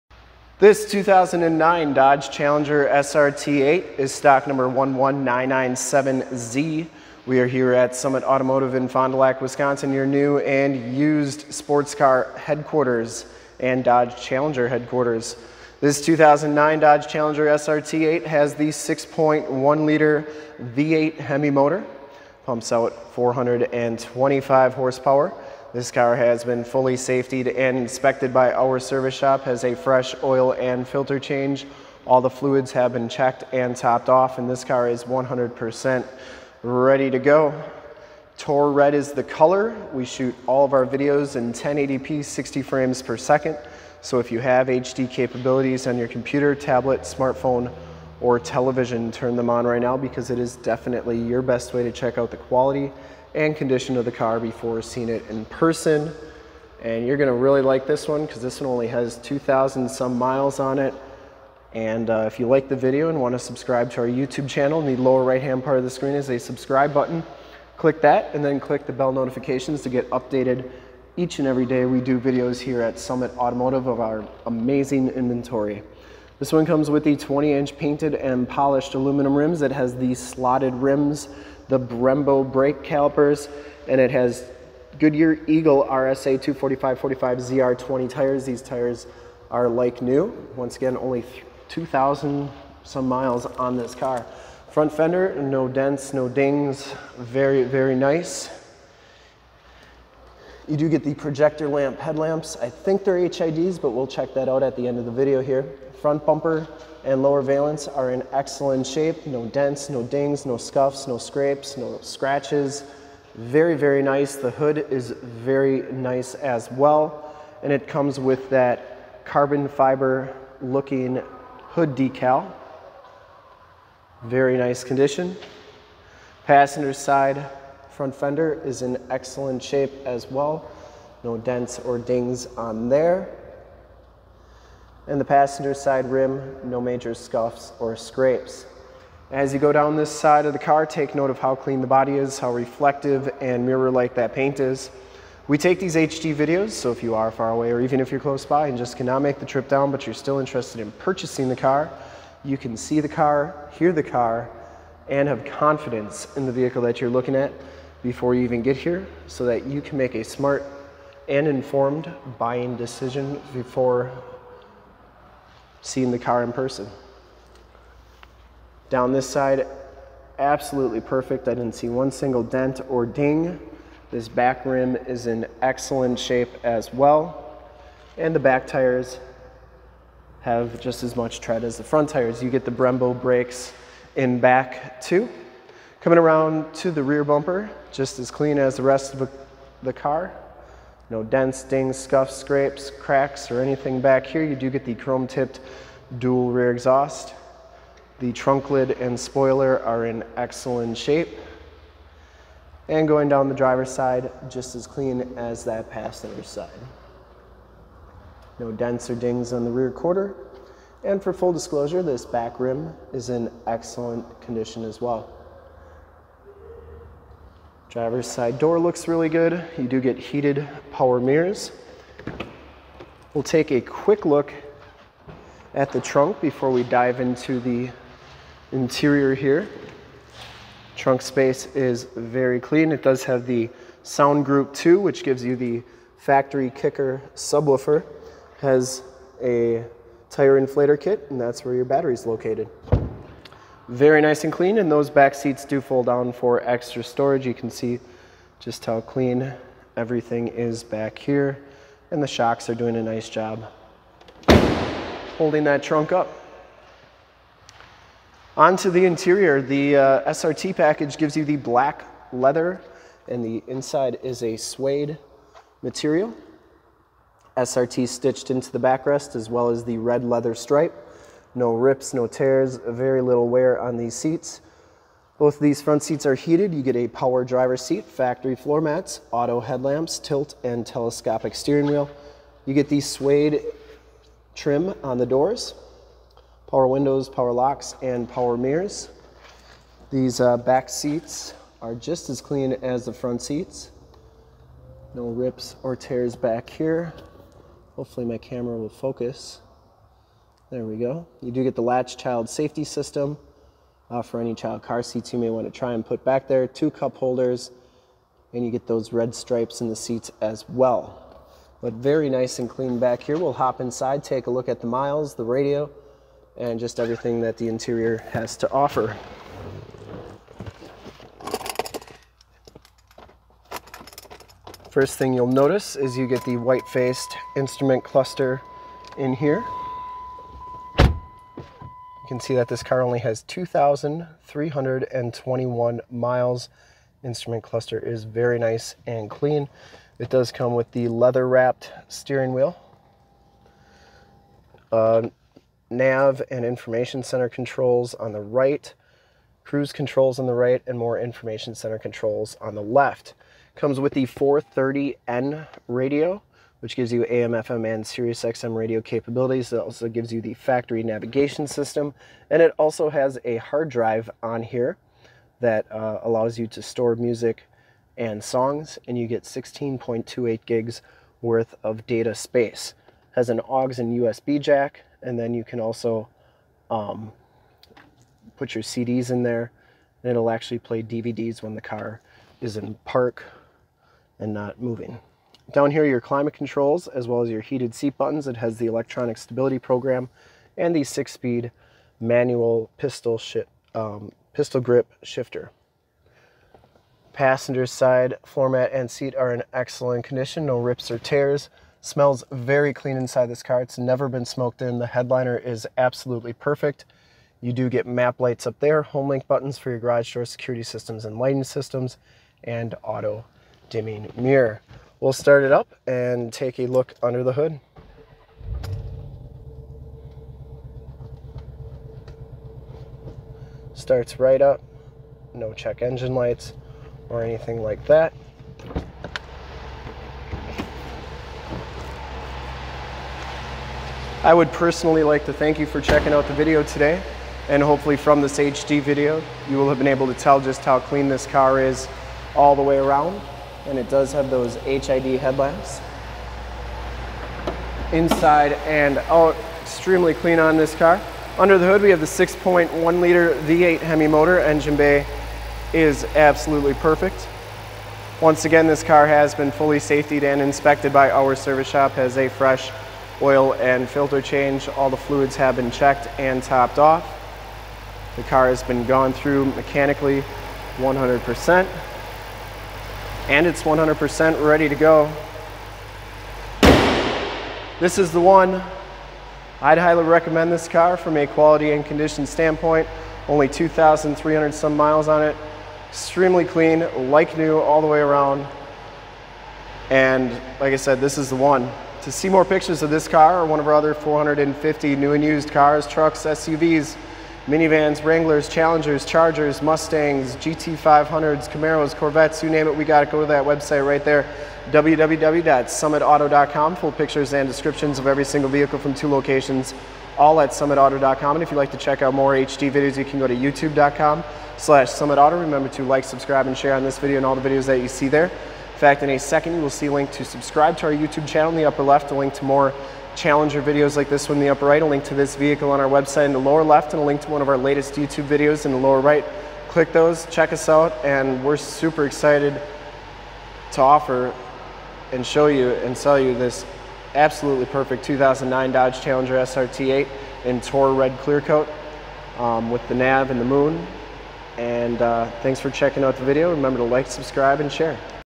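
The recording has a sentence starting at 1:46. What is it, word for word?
Front bumper and lower valence are in excellent shape.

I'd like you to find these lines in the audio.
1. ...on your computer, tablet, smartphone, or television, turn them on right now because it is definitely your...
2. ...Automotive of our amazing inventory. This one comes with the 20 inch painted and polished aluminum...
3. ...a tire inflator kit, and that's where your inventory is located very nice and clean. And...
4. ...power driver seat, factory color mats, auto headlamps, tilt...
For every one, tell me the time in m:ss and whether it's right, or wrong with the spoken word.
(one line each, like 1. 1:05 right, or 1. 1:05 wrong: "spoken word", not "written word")
1. 0:45 right
2. 1:13 right
3. 3:59 wrong: "battery", not "inventory"
4. 4:37 wrong: "floor", not "color".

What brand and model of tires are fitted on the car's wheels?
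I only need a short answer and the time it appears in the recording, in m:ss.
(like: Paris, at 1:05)
Goodyear Eagle RSA, at 1:24.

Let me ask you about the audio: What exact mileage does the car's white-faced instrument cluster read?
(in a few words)
2,321.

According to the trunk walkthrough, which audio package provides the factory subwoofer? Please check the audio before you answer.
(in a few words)
Sound Group 2.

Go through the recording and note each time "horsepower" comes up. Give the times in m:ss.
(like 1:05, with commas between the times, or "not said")
0:24.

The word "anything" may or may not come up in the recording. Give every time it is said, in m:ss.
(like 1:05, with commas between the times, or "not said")
3:13, 7:07.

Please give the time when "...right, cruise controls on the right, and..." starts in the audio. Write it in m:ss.
5:48.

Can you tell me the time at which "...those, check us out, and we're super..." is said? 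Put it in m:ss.
8:50.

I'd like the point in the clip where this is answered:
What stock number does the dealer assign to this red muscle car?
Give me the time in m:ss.
0:04.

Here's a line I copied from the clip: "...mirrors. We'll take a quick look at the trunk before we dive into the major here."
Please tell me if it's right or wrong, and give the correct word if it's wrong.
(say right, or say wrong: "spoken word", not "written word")
wrong: "interior", not "major".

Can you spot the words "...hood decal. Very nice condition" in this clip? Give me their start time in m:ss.
2:01.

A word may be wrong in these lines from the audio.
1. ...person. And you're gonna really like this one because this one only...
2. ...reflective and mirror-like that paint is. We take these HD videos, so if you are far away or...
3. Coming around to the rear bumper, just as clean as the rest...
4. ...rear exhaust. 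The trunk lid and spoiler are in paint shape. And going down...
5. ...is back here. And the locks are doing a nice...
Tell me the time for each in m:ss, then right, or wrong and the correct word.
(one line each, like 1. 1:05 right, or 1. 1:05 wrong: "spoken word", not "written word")
1. 0:55 right
2. 2:22 right
3. 3:06 right
4. 3:16 wrong: "excellent", not "paint"
5. 4:10 wrong: "shocks", not "locks".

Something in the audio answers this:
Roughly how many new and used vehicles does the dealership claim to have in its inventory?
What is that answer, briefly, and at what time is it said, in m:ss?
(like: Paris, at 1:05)
450, at 8:14.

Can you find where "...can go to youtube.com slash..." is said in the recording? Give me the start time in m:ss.
8:33.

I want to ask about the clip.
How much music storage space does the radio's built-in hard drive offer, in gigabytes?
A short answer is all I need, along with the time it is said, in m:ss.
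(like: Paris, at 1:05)
16.28, at 6:09.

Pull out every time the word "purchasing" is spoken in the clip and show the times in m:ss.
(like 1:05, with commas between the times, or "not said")
2:30.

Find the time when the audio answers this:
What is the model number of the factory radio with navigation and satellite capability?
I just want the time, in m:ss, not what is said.
5:54.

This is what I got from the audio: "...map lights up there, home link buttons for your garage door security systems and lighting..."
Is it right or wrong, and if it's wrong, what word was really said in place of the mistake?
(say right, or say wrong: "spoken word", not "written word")
right.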